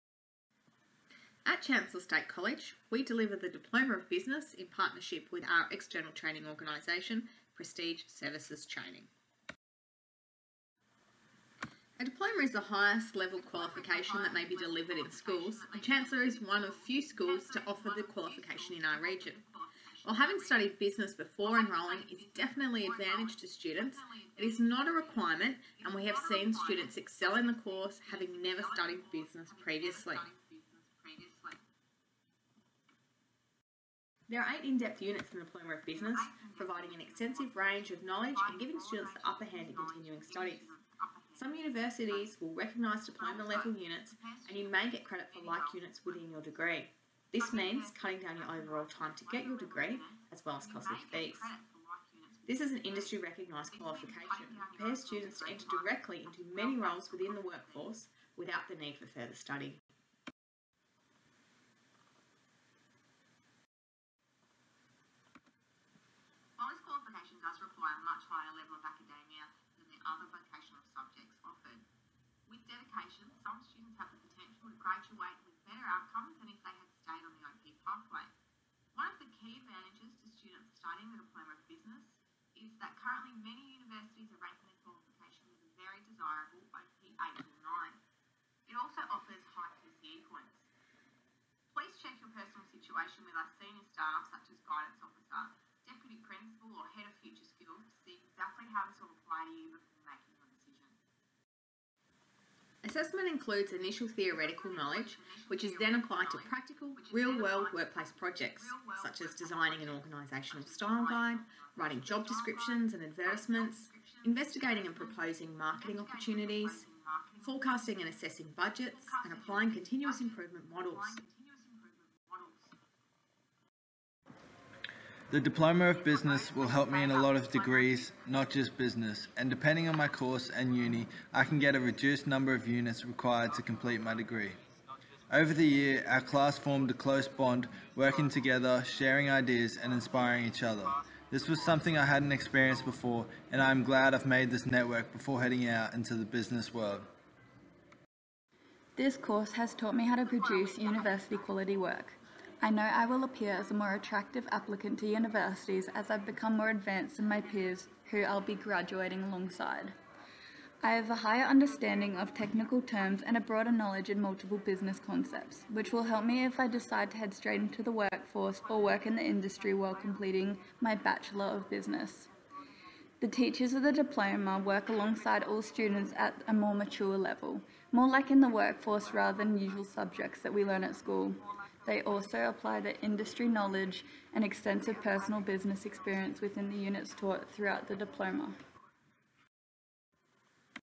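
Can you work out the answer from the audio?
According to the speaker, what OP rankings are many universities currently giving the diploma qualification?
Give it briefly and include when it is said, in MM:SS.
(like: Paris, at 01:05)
OP 8 or 9, at 01:26.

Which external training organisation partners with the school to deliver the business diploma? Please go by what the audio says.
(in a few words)
Prestige Services Training.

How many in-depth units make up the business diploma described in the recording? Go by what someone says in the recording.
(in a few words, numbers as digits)
8.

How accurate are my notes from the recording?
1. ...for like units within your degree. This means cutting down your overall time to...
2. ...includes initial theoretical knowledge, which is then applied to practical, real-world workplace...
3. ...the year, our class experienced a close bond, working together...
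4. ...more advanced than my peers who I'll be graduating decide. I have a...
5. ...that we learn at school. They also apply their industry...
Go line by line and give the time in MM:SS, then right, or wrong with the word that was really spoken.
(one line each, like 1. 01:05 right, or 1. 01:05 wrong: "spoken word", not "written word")
1. 00:45 right
2. 01:43 right
3. 02:15 wrong: "formed", not "experienced"
4. 02:36 wrong: "alongside", not "decide"
5. 03:00 right.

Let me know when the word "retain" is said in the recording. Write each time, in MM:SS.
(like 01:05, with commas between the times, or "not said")
not said.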